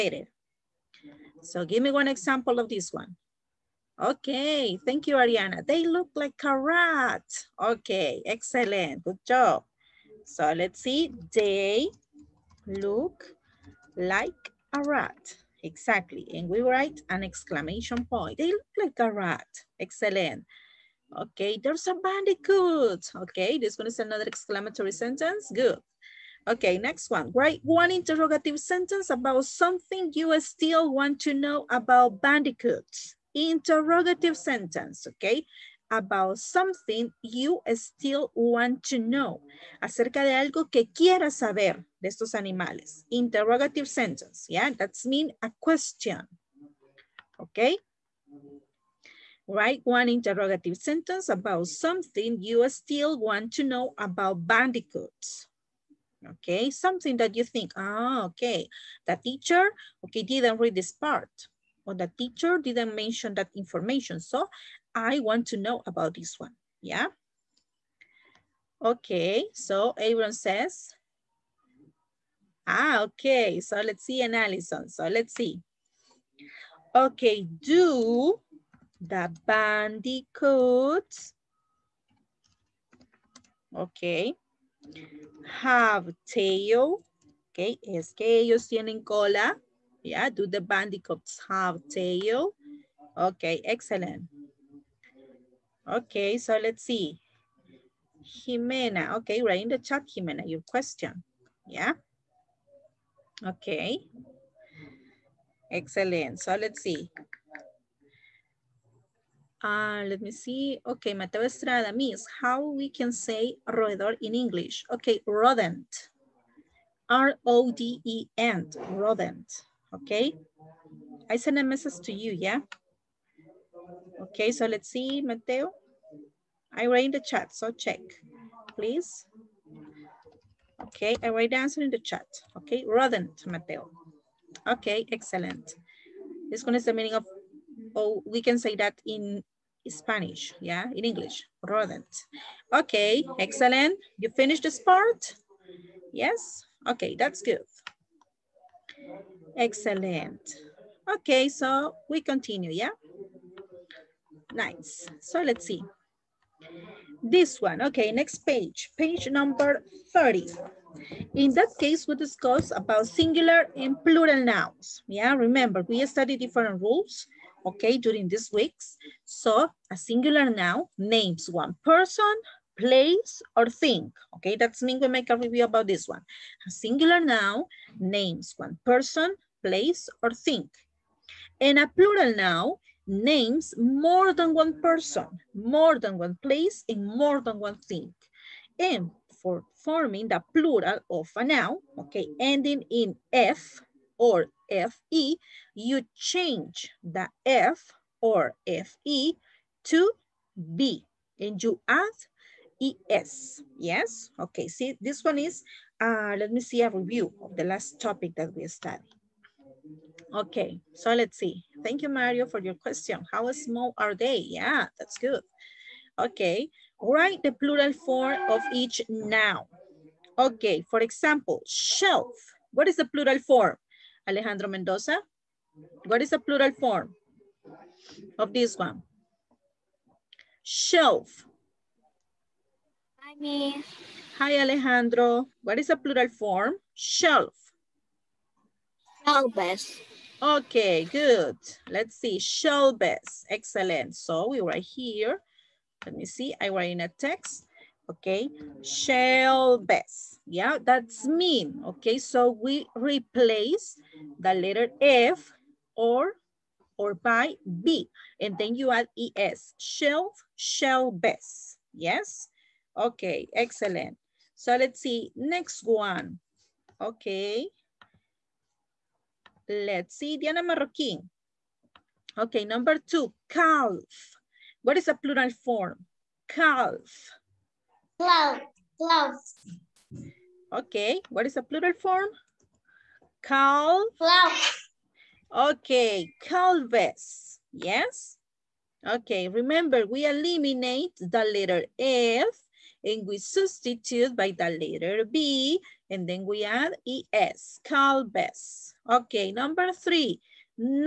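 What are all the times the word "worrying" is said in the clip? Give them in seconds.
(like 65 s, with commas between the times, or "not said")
not said.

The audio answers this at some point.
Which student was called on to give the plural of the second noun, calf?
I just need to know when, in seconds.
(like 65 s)
270 s.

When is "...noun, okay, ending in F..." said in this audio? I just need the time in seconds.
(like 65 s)
191 s.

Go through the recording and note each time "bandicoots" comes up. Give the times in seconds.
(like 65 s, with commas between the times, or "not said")
21 s, 32 s, 54 s, 79 s, 90 s.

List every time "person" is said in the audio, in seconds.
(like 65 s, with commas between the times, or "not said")
171 s, 178 s, 184 s.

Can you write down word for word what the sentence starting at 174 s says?
Okay, that's mean we make a review about this one.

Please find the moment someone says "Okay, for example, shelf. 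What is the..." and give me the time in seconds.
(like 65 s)
220 s.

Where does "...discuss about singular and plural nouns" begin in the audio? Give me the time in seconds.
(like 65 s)
162 s.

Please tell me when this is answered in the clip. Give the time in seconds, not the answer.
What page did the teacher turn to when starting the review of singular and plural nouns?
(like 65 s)
158 s.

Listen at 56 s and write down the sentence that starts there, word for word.
Okay, something that you think, ah, oh, okay, the teacher, okay, didn't read this part or the teacher didn't mention that information.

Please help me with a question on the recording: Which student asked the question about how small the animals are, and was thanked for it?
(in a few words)
Mario.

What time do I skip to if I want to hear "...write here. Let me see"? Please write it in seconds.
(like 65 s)
244 s.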